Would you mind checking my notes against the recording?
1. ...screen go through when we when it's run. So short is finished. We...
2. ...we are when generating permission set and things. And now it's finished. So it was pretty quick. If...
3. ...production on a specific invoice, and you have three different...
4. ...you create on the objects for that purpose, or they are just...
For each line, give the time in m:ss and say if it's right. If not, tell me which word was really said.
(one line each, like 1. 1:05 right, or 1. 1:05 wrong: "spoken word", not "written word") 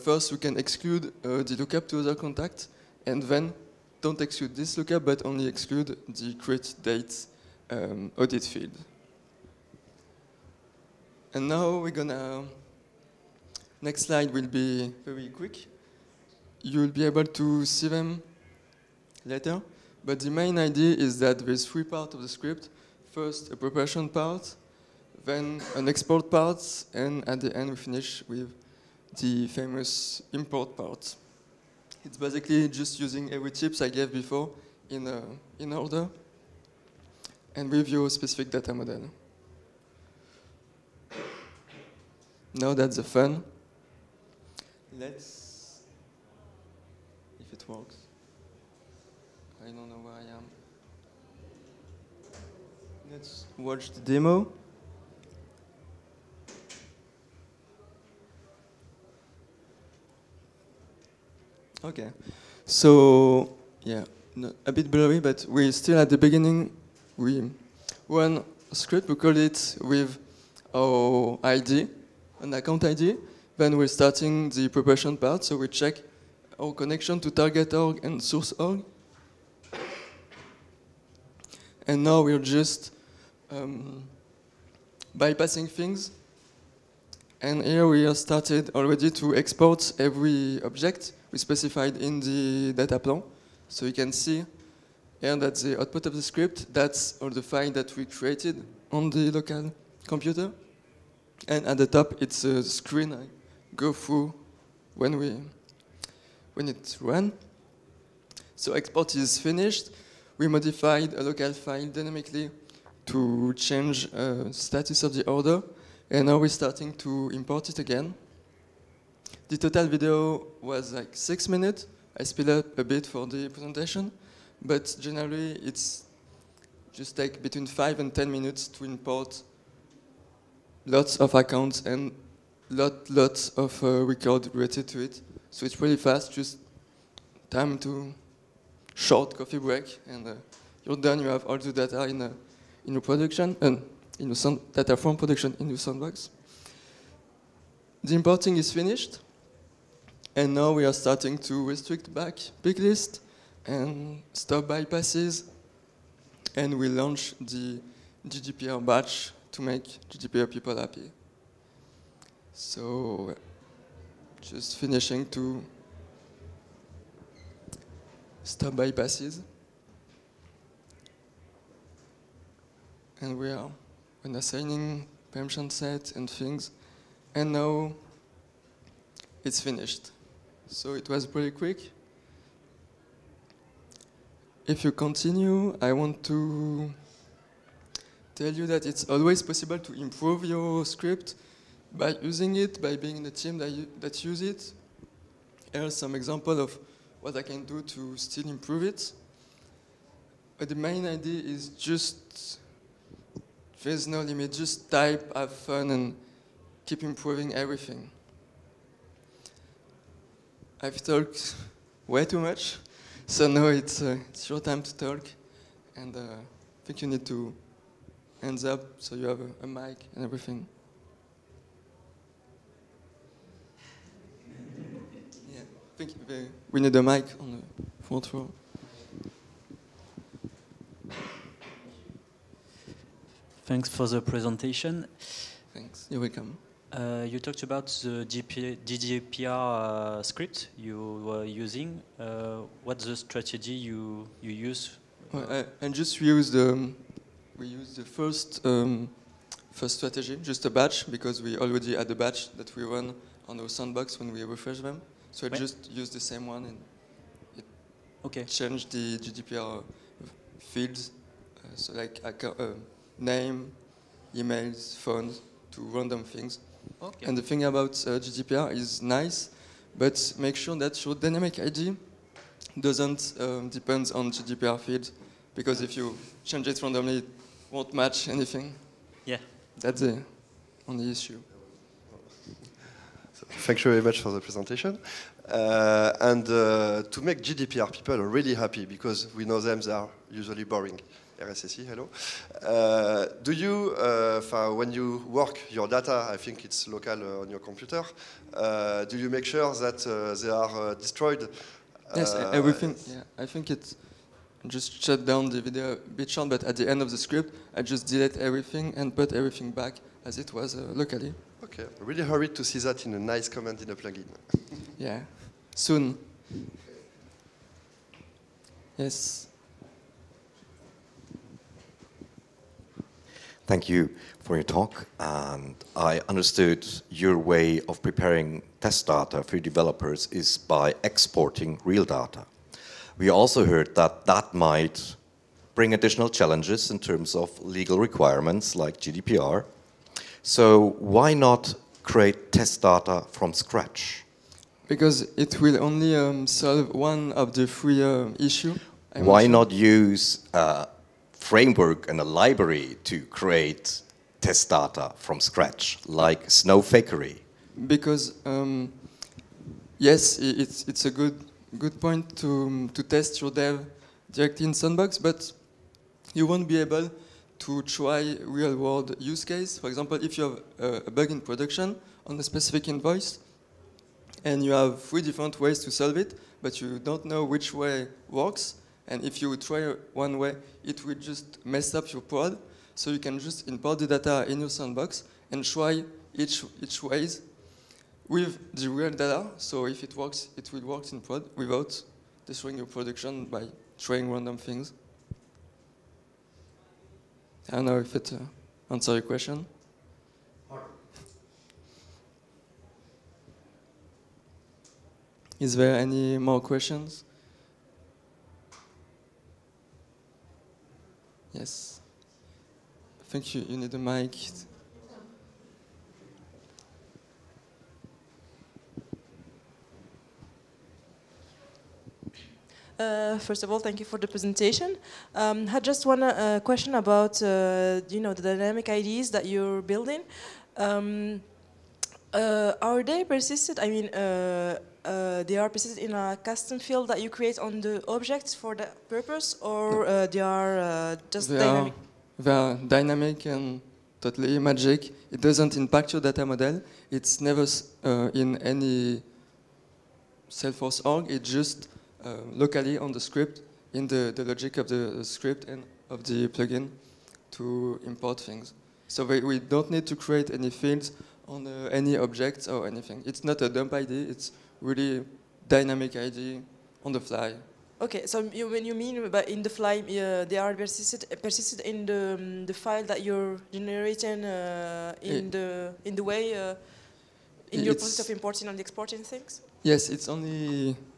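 1. 1:42 wrong: "export", not "short"
2. 2:53 wrong: "assigning", not "generating"
3. 6:11 right
4. 7:17 right.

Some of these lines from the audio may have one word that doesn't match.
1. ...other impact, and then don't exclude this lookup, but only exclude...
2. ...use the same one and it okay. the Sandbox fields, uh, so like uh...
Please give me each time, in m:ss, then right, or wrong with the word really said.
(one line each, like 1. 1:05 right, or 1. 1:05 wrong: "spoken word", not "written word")
1. 0:01 wrong: "contact", not "impact"
2. 4:15 wrong: "GDPR", not "Sandbox".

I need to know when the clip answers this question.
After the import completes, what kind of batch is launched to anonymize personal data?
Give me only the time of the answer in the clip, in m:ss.
2:38.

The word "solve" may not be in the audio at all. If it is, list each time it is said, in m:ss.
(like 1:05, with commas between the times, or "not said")
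5:46, 6:15.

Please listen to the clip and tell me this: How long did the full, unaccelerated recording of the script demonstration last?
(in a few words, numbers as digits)
6 minutes.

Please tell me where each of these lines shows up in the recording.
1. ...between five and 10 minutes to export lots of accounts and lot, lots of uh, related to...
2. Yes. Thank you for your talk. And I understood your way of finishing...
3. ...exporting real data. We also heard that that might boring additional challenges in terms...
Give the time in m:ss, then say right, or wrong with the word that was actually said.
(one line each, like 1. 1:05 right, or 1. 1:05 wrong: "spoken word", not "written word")
1. 2:07 wrong: "import", not "export"
2. 5:18 wrong: "preparing", not "finishing"
3. 5:31 wrong: "bring", not "boring".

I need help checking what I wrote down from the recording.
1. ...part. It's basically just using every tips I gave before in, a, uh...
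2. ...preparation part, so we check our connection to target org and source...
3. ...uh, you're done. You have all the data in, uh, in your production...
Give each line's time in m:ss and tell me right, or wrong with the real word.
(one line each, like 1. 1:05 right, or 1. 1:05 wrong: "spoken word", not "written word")
1. 0:30 right
2. 1:14 right
3. 2:20 right.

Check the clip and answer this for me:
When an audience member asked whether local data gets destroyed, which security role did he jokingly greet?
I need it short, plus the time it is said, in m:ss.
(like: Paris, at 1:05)
RSSI, at 4:51.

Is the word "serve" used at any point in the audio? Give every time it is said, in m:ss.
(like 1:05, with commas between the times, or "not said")
not said.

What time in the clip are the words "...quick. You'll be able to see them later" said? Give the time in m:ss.
0:15.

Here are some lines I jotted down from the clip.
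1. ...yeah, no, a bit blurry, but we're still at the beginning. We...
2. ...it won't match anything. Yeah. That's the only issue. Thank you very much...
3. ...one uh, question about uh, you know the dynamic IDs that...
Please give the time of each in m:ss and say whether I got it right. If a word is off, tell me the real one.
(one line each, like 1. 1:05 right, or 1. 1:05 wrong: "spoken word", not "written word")
1. 1:03 right
2. 4:37 right
3. 7:06 right.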